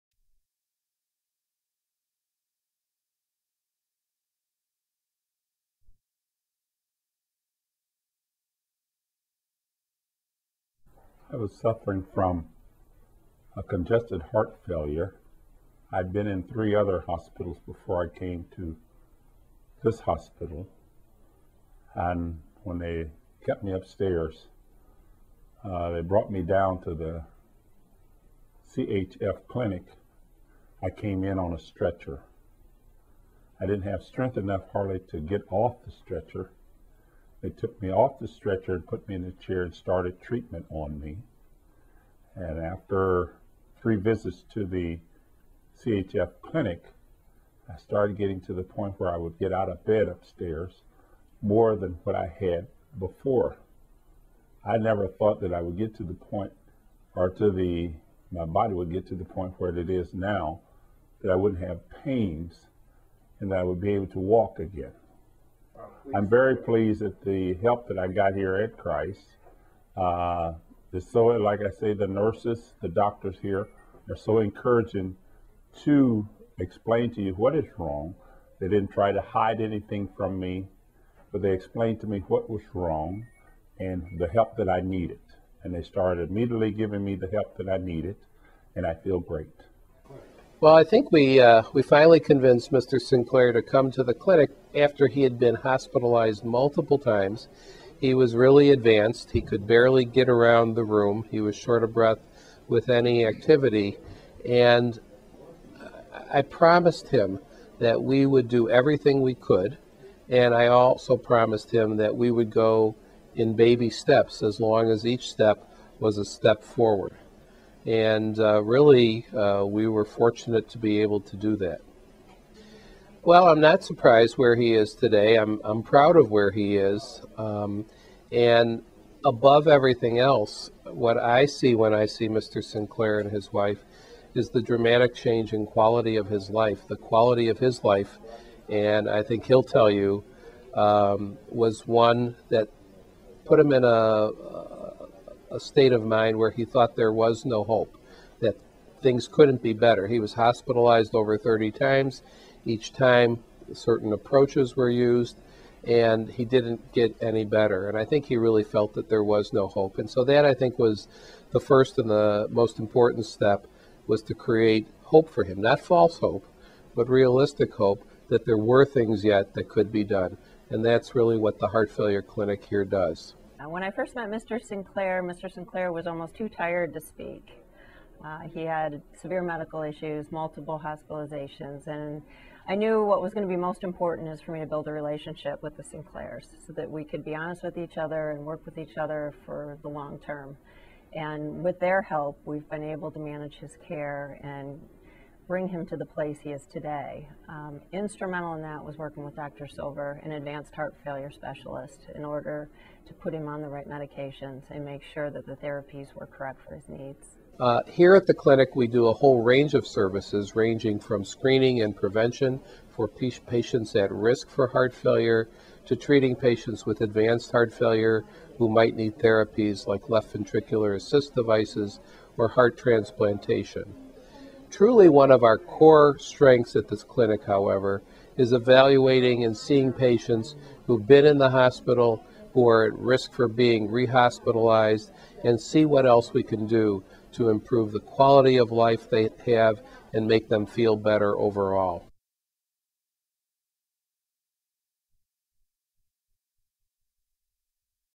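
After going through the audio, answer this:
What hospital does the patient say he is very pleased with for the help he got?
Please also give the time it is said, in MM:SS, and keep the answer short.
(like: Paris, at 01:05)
Christ, at 01:08.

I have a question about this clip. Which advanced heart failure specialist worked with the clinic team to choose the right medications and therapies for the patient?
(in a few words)
Dr. Silver.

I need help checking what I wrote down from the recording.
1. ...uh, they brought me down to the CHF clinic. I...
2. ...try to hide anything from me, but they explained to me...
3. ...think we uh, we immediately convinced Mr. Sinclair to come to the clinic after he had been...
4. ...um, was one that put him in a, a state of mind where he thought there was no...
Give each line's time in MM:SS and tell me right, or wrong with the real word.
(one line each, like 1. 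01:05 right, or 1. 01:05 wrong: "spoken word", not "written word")
1. 00:25 right
2. 01:18 right
3. 01:30 wrong: "finally", not "immediately"
4. 02:20 right.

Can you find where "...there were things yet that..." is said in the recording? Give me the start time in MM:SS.
02:48.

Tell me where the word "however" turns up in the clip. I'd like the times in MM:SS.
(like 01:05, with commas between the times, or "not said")
03:47.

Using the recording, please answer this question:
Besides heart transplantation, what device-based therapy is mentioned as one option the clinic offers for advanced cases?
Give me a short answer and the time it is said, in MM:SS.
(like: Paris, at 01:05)
left ventricular assist devices, at 03:40.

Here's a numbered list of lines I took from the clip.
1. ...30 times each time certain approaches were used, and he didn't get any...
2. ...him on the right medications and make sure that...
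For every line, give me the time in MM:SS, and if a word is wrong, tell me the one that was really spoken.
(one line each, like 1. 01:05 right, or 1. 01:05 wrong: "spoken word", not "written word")
1. 02:31 right
2. 03:23 right.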